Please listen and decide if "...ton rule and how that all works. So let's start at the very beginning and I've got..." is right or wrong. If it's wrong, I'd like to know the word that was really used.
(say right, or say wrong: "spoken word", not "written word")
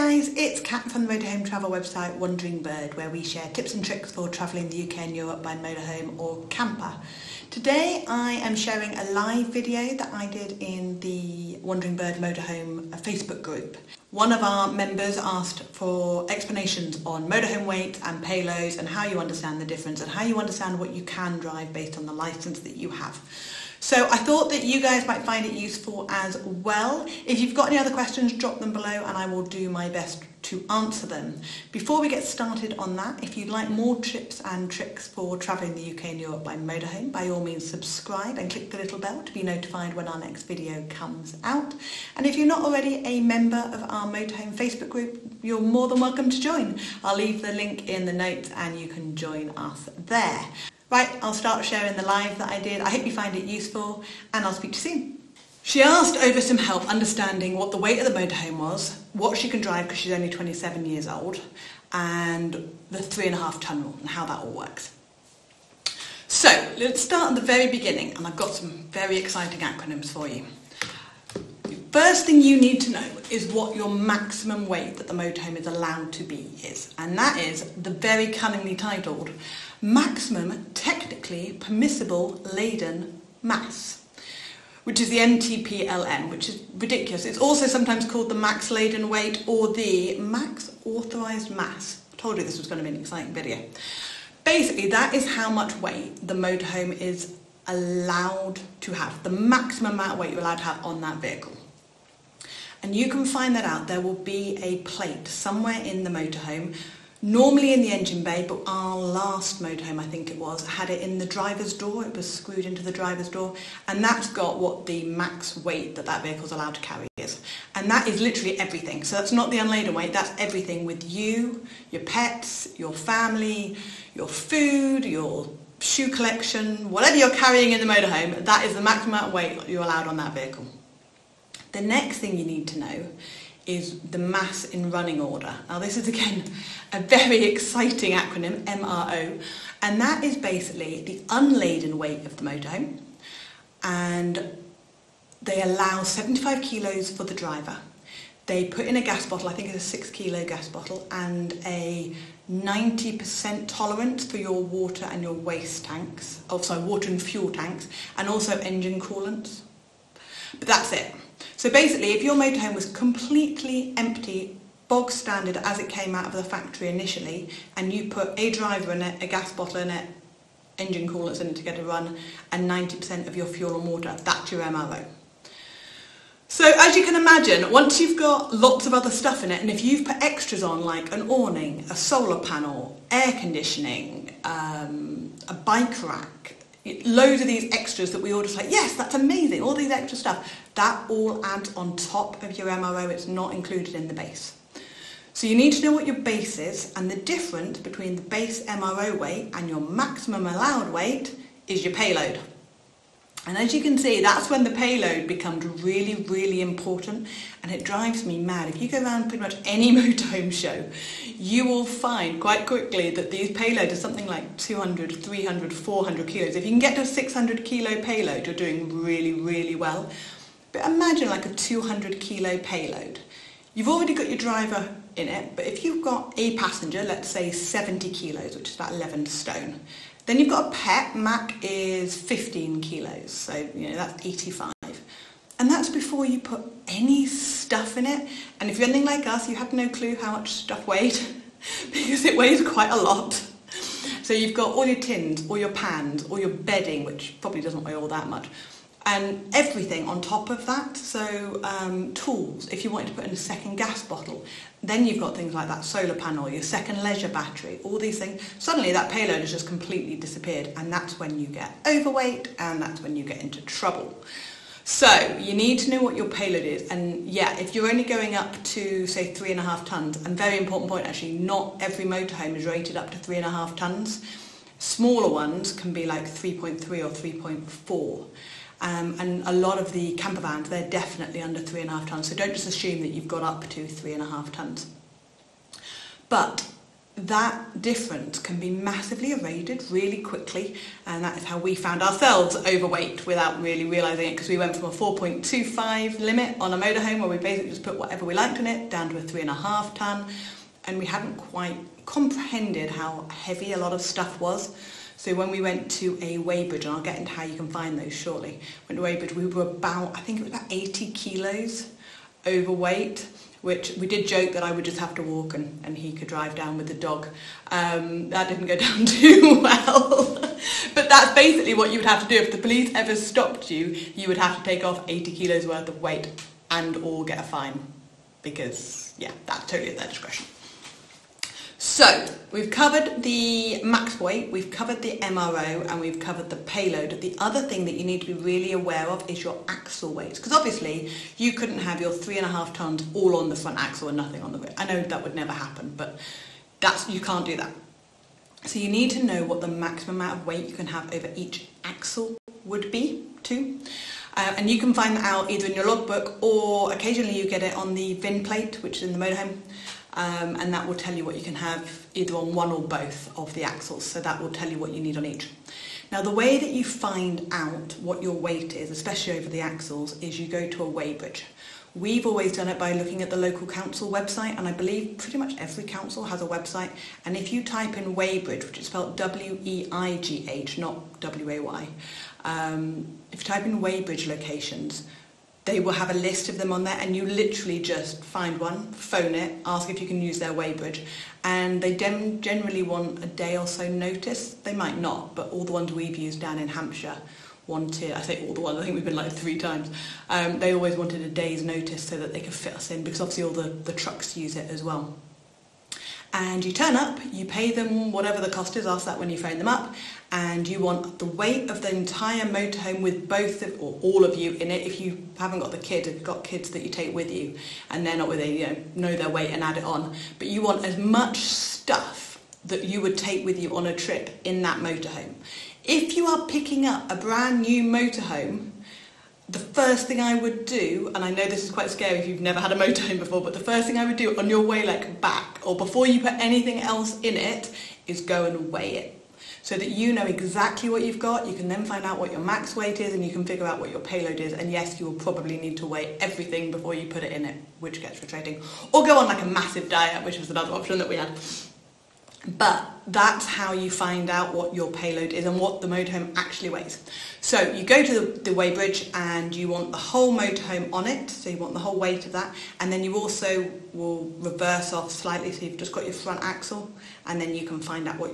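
right.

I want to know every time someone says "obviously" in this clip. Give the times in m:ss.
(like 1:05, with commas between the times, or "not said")
5:40, 6:43.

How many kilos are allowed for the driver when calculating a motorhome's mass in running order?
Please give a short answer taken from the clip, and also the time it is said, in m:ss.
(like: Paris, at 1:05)
75 kilos, at 2:26.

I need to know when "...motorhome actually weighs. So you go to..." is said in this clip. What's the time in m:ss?
7:35.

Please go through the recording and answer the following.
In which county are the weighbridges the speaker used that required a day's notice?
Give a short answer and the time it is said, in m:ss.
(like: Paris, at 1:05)
Hampshire, at 6:36.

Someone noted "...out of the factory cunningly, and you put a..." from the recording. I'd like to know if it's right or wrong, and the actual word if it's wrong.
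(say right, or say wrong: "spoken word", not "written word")
wrong: "initially", not "cunningly".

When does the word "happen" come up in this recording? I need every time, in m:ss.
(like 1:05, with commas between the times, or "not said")
5:45.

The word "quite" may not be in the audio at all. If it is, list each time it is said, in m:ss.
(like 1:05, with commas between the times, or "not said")
3:32, 4:02, 5:01, 7:11.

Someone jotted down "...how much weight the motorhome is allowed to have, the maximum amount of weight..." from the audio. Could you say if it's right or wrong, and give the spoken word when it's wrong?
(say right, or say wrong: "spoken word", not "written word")
right.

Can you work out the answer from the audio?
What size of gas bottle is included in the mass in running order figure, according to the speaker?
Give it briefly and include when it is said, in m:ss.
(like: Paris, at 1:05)
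6 kilo, at 2:29.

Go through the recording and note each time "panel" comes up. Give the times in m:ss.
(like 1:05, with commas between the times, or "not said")
3:02, 4:16.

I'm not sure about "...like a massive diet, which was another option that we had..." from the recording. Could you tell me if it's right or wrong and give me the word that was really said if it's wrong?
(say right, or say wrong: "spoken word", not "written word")
right.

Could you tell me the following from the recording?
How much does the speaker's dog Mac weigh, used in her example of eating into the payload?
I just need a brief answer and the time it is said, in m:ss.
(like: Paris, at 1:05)
15 kilos, at 3:52.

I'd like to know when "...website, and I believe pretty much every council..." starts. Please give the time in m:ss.
6:14.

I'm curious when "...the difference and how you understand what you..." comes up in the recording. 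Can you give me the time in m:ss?
0:19.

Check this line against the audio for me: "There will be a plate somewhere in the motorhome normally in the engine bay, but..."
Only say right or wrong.
right.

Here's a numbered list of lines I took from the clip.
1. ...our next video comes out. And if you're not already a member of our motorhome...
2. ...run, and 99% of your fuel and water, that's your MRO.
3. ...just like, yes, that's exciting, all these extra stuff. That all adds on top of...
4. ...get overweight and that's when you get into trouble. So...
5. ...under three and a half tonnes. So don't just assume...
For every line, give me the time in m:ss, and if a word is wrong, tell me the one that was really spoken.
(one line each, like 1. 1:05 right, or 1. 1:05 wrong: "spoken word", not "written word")
1. 0:40 right
2. 2:51 wrong: "90", not "99"
3. 3:08 wrong: "amazing", not "exciting"
4. 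4:21 right
5. 4:41 right.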